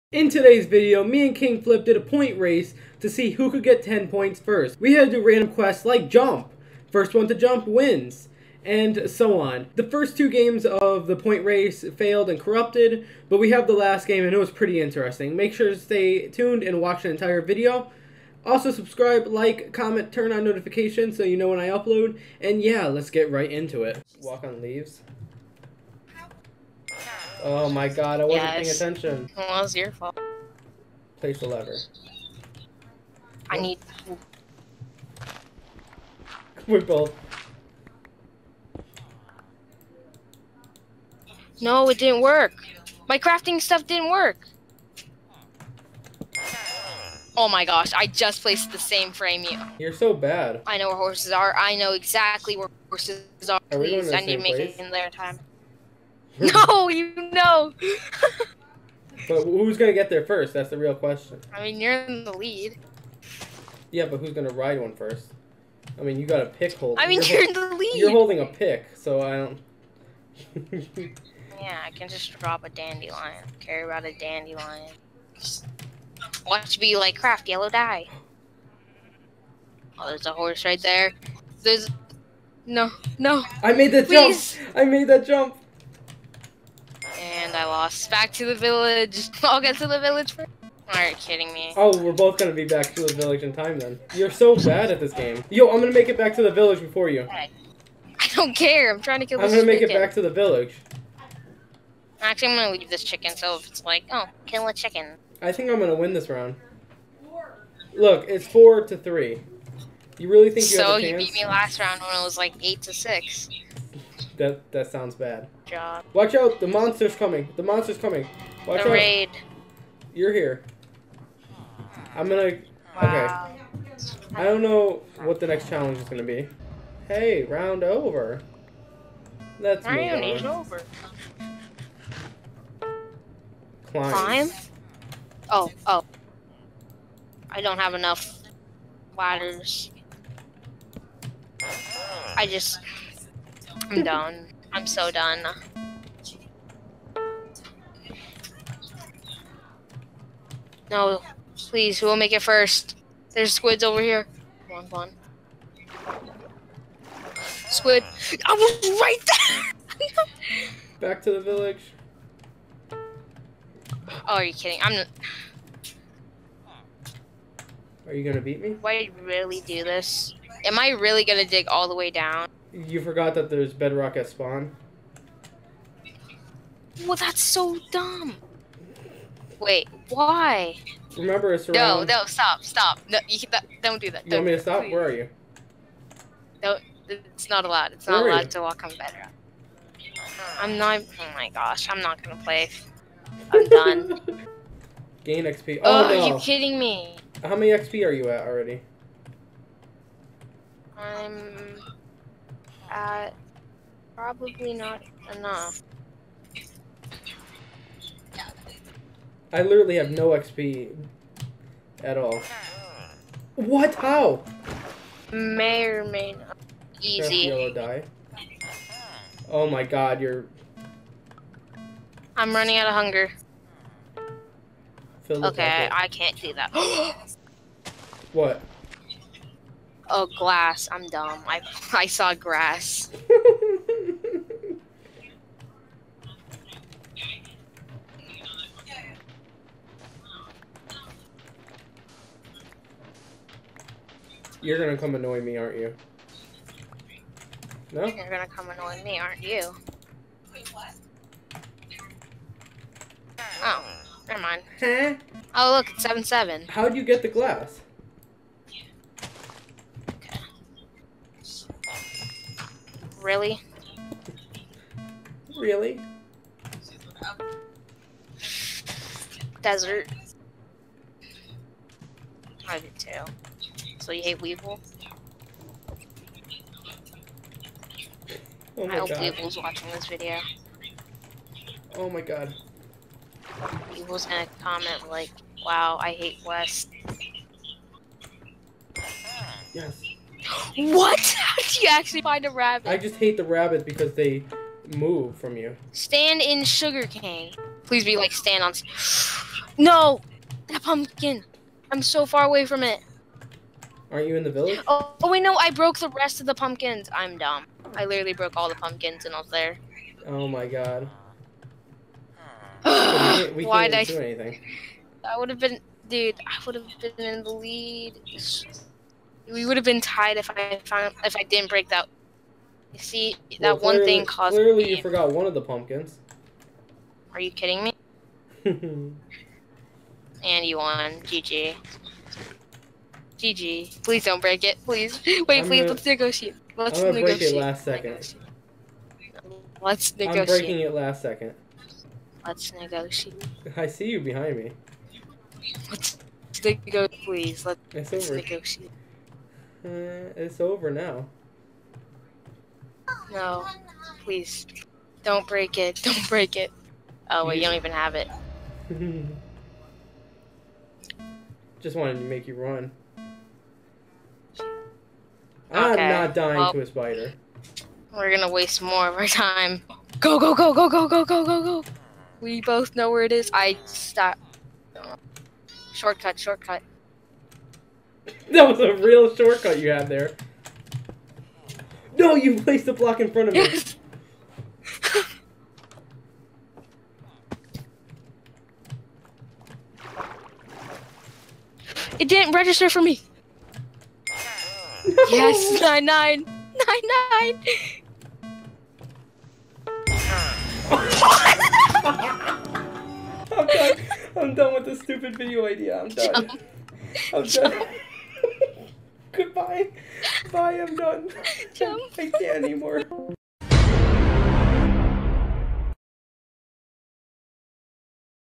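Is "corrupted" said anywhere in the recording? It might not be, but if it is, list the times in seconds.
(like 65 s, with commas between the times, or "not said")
12 s.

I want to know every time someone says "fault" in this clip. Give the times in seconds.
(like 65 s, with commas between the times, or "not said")
29 s.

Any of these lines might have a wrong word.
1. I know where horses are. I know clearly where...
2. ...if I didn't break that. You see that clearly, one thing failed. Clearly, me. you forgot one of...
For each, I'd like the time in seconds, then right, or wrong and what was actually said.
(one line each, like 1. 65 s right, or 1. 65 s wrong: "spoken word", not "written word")
1. 50 s wrong: "exactly", not "clearly"
2. 321 s wrong: "caused", not "failed".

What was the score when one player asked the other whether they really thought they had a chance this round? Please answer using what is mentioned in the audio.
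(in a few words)
4 to 3.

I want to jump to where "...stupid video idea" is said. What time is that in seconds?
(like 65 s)
405 s.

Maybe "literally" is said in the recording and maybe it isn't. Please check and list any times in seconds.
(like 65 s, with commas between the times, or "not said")
209 s, 308 s.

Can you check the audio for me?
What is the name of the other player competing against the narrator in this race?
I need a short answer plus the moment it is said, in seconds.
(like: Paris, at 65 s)
King Flip, at 1 s.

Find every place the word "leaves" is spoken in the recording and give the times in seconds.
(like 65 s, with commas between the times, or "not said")
24 s, 102 s.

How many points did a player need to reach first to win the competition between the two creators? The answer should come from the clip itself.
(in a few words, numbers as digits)
10.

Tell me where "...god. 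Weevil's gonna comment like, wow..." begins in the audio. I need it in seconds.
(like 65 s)
282 s.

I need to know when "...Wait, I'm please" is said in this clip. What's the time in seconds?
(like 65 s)
335 s.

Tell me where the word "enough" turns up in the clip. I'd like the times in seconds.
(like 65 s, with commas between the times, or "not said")
137 s, 205 s.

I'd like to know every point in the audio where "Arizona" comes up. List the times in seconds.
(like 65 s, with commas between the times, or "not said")
not said.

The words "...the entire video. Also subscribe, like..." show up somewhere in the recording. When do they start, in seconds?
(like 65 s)
17 s.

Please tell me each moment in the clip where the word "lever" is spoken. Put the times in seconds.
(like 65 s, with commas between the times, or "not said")
31 s.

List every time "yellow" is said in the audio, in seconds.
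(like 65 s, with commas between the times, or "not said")
77 s, 217 s.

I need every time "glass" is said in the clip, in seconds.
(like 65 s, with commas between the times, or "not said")
230 s, 257 s.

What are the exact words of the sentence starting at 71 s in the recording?
yeah, I can just drop a dandelion.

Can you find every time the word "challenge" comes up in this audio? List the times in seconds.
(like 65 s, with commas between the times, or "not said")
125 s.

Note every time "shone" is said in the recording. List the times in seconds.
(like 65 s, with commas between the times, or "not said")
not said.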